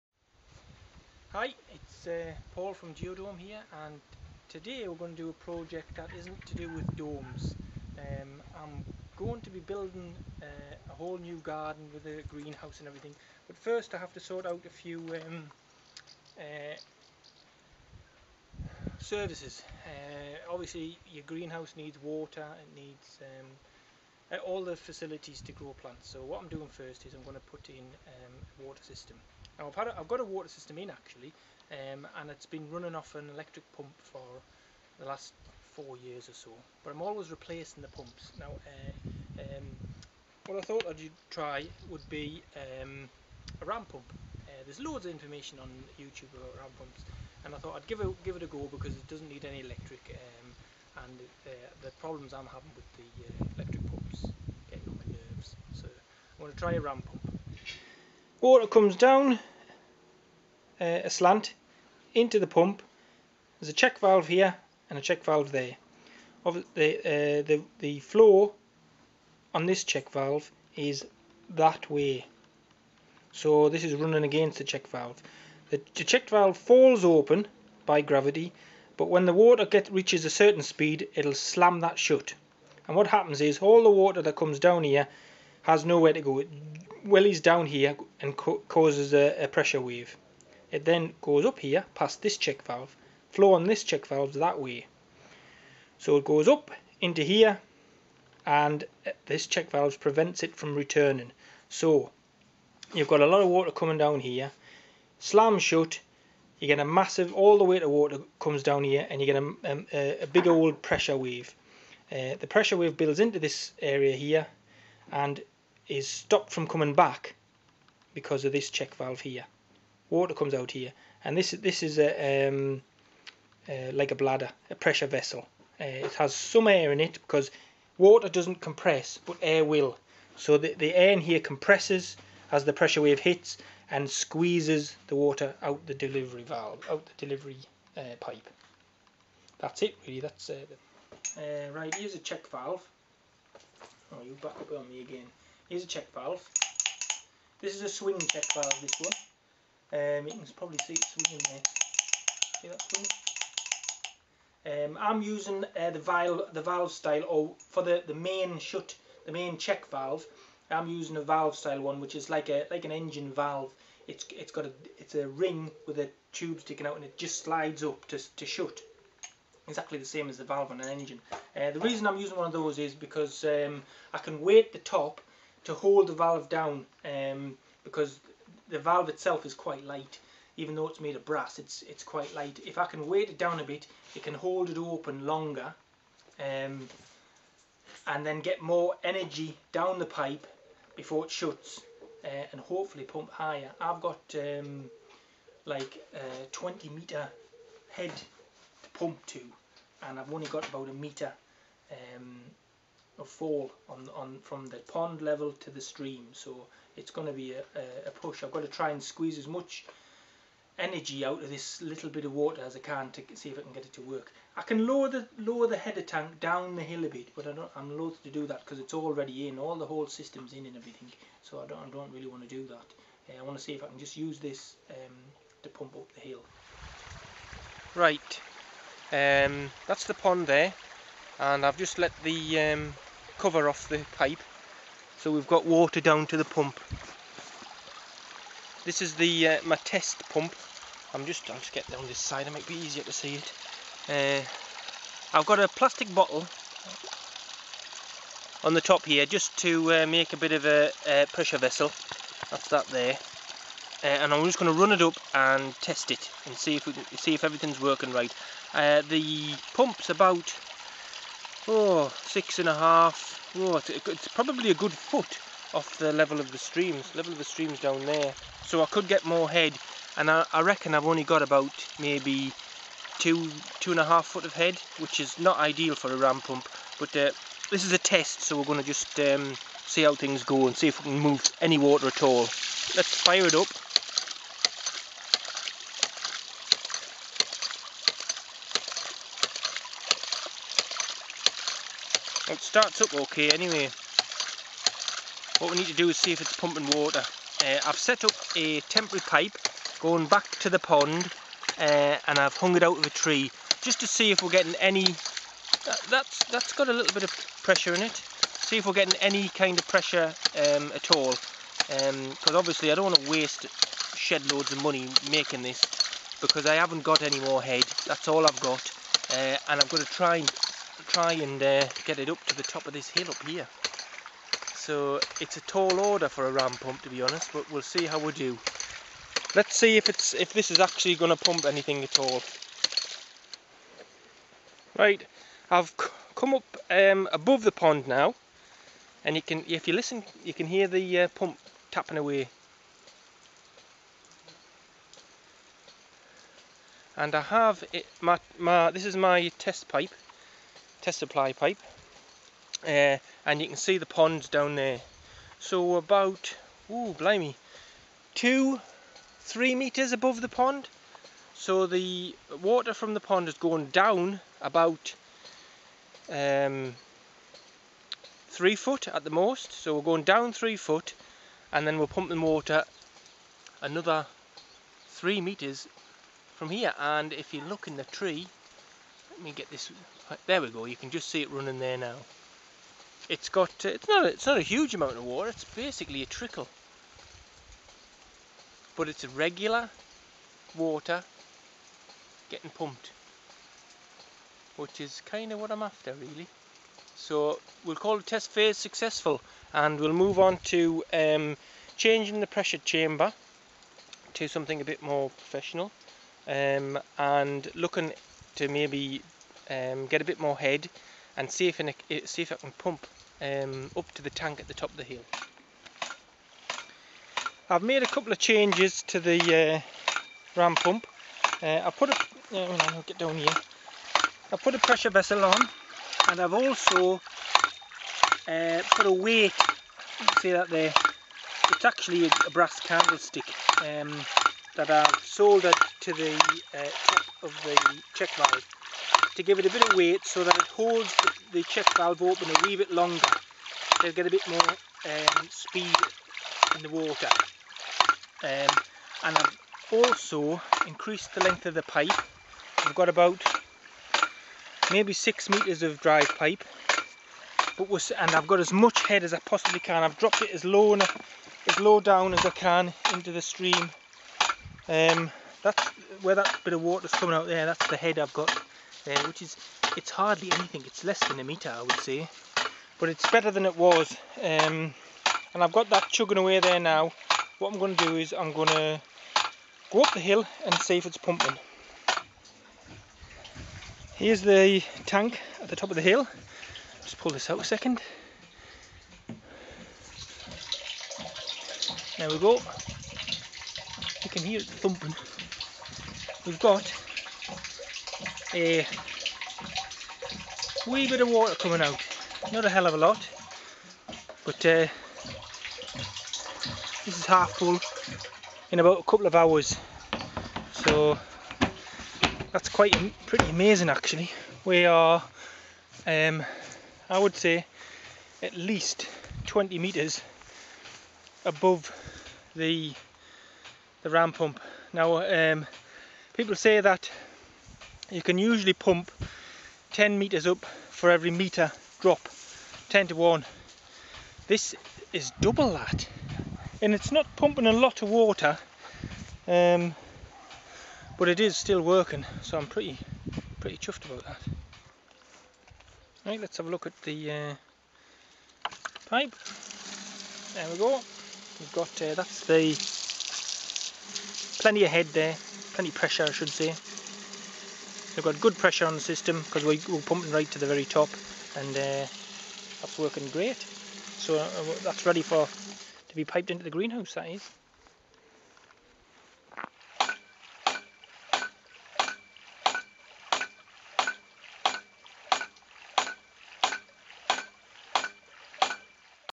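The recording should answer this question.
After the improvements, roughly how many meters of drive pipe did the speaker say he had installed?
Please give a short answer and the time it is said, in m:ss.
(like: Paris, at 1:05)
6 meters, at 7:35.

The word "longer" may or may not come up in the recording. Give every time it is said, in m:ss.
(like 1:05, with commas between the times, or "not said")
3:05, 7:22.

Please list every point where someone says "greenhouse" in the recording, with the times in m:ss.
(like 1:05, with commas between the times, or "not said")
0:12, 0:21, 9:26.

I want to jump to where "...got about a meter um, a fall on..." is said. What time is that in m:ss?
3:20.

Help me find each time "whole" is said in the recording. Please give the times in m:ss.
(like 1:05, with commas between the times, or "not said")
0:10, 3:39.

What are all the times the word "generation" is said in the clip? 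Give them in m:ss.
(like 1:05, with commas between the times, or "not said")
not said.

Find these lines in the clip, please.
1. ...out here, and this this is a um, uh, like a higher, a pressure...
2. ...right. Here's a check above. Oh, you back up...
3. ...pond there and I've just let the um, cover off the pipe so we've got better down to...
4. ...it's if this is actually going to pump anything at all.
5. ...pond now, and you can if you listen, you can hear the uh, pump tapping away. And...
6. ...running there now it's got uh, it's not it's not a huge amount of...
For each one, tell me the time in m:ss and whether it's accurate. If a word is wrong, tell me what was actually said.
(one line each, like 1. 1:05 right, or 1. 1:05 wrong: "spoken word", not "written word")
1. 2:00 wrong: "bladder", not "higher"
2. 2:21 wrong: "valve", not "above"
3. 3:50 wrong: "water", not "better"
4. 5:30 right
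5. 5:37 right
6. 6:21 right.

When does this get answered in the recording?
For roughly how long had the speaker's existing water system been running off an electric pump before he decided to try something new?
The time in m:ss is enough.
0:35.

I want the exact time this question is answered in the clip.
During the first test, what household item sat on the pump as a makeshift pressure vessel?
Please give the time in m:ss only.
4:05.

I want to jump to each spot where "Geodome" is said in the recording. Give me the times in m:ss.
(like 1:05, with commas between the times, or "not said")
0:02.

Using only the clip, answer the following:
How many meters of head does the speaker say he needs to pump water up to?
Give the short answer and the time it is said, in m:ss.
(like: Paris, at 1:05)
20 meters, at 3:16.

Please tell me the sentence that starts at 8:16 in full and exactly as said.
We've got a eh, wee bit of water coming out.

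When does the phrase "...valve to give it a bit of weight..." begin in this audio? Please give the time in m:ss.
7:18.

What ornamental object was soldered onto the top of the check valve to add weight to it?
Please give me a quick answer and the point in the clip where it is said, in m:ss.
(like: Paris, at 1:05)
brass candlestick, at 7:12.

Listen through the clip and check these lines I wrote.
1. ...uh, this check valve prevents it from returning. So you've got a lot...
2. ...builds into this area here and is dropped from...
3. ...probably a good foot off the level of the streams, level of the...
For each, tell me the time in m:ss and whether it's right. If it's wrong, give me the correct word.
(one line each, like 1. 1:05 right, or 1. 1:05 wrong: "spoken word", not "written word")
1. 1:39 right
2. 1:52 wrong: "stopped", not "dropped"
3. 4:24 right.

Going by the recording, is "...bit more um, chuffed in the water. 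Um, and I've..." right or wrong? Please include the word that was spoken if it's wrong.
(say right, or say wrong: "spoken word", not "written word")
wrong: "speed", not "chuffed".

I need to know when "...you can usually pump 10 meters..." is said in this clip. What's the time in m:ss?
8:48.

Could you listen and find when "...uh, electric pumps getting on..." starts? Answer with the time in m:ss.
0:53.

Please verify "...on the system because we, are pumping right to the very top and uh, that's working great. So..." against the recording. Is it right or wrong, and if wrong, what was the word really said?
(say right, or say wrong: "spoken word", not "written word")
right.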